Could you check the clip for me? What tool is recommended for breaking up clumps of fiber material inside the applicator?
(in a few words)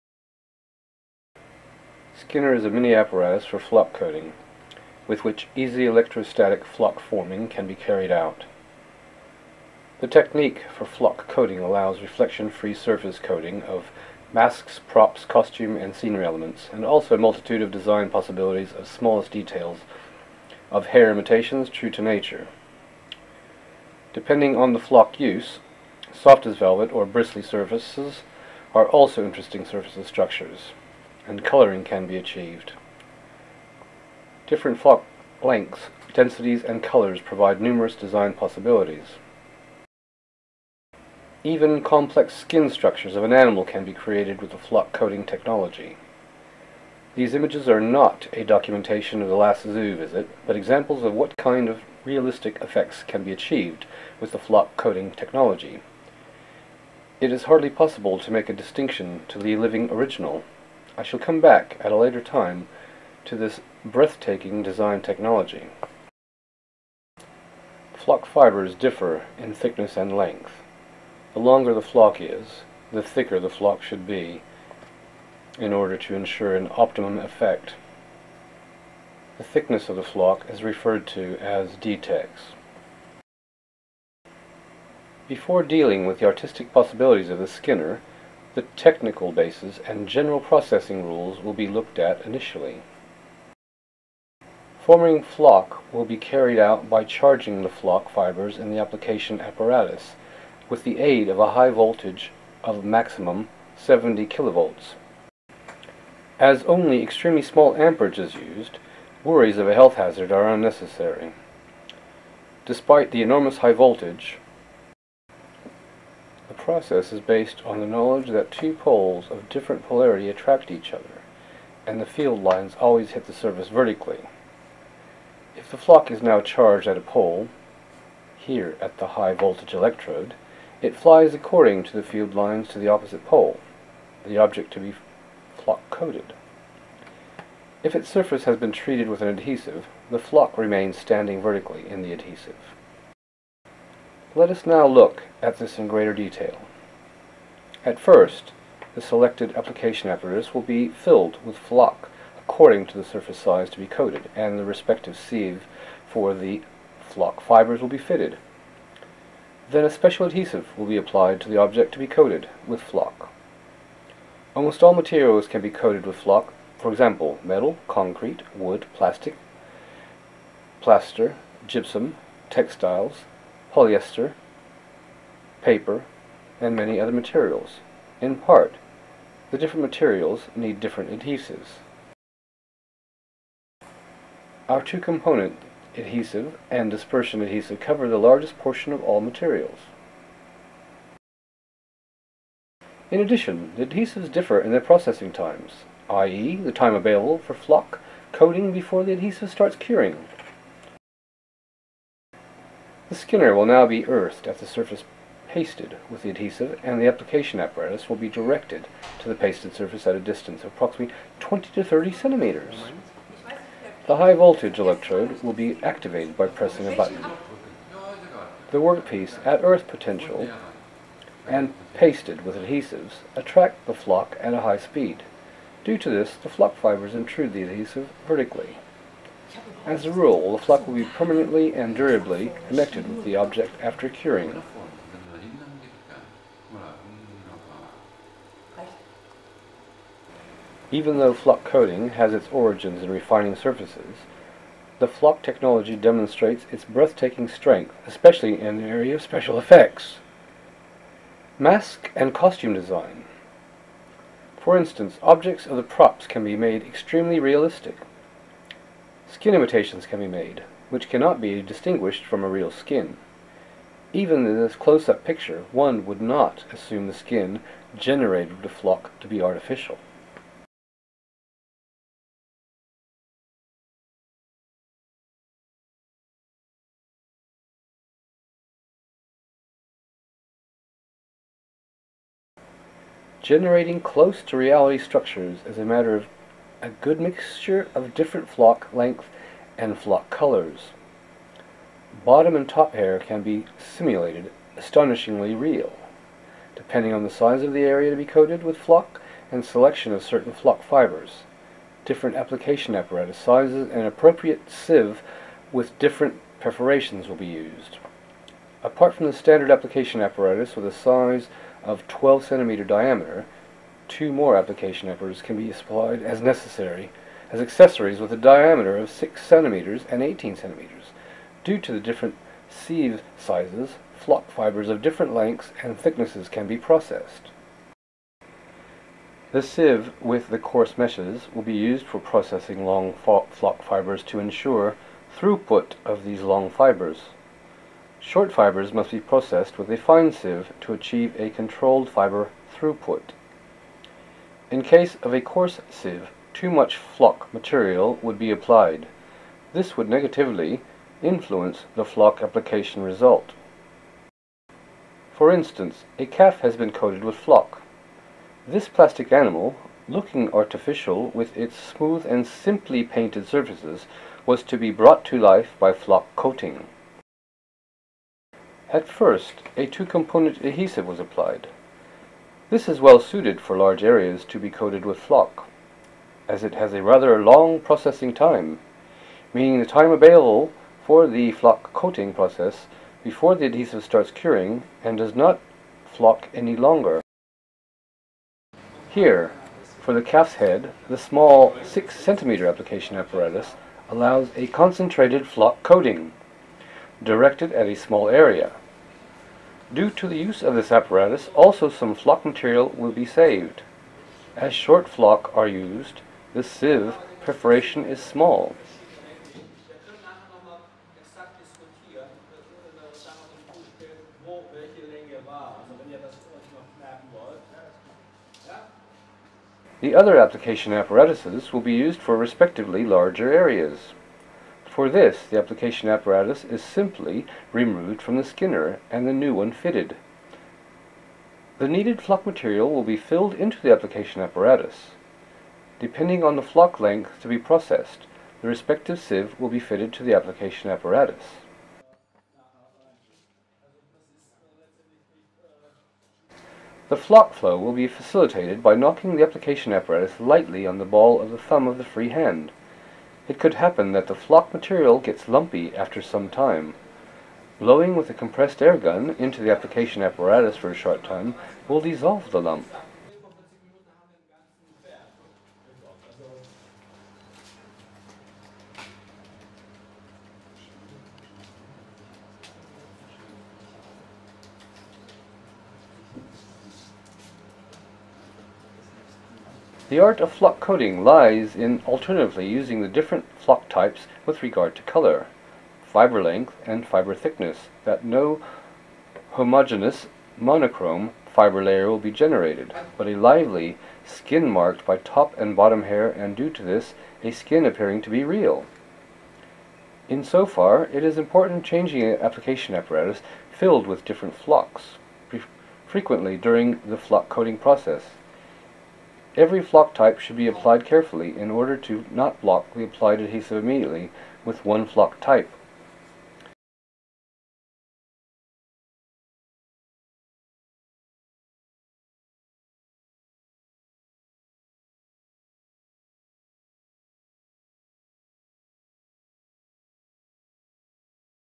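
compressed air gun.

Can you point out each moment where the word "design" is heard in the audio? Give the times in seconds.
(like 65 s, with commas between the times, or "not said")
17 s, 37 s, 64 s, 252 s.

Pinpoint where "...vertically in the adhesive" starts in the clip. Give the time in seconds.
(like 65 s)
141 s.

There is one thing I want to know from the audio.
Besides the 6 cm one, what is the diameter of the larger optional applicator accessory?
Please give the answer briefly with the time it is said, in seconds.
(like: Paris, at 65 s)
18 centimeters, at 320 s.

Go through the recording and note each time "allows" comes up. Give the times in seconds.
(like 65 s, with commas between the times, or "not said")
11 s, 394 s.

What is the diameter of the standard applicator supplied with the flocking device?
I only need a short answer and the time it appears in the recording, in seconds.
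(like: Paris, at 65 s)
12 centimeters, at 312 s.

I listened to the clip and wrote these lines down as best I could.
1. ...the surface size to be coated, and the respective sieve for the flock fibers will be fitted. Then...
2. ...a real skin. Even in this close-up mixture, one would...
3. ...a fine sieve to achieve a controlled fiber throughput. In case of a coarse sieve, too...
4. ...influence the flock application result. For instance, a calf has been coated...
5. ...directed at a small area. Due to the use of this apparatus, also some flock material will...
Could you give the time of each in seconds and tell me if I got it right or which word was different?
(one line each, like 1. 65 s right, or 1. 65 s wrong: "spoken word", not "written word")
1. 152 s right
2. 262 s wrong: "picture", not "mixture"
3. 339 s right
4. 351 s right
5. 397 s right.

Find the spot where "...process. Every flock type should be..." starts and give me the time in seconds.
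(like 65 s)
507 s.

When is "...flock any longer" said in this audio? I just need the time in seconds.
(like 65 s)
386 s.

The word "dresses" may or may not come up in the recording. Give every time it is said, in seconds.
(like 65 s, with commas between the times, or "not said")
not said.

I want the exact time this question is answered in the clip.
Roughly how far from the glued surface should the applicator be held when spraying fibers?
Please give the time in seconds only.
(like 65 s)
211 s.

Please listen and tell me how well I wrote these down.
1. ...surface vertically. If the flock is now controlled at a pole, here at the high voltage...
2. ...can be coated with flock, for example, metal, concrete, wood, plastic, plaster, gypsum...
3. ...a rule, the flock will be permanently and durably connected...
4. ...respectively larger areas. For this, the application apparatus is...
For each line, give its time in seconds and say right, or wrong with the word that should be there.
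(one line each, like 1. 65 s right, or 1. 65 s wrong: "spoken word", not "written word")
1. 123 s wrong: "charged", not "controlled"
2. 165 s right
3. 230 s right
4. 422 s right.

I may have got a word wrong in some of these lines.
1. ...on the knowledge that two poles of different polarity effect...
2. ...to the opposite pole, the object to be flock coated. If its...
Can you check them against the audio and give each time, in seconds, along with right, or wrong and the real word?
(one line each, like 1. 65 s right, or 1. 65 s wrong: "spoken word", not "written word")
1. 117 s wrong: "attract", not "effect"
2. 132 s right.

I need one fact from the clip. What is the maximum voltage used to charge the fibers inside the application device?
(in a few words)
70 kilovolts.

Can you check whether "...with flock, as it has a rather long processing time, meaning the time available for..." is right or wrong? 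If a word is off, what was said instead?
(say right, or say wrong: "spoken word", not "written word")
right.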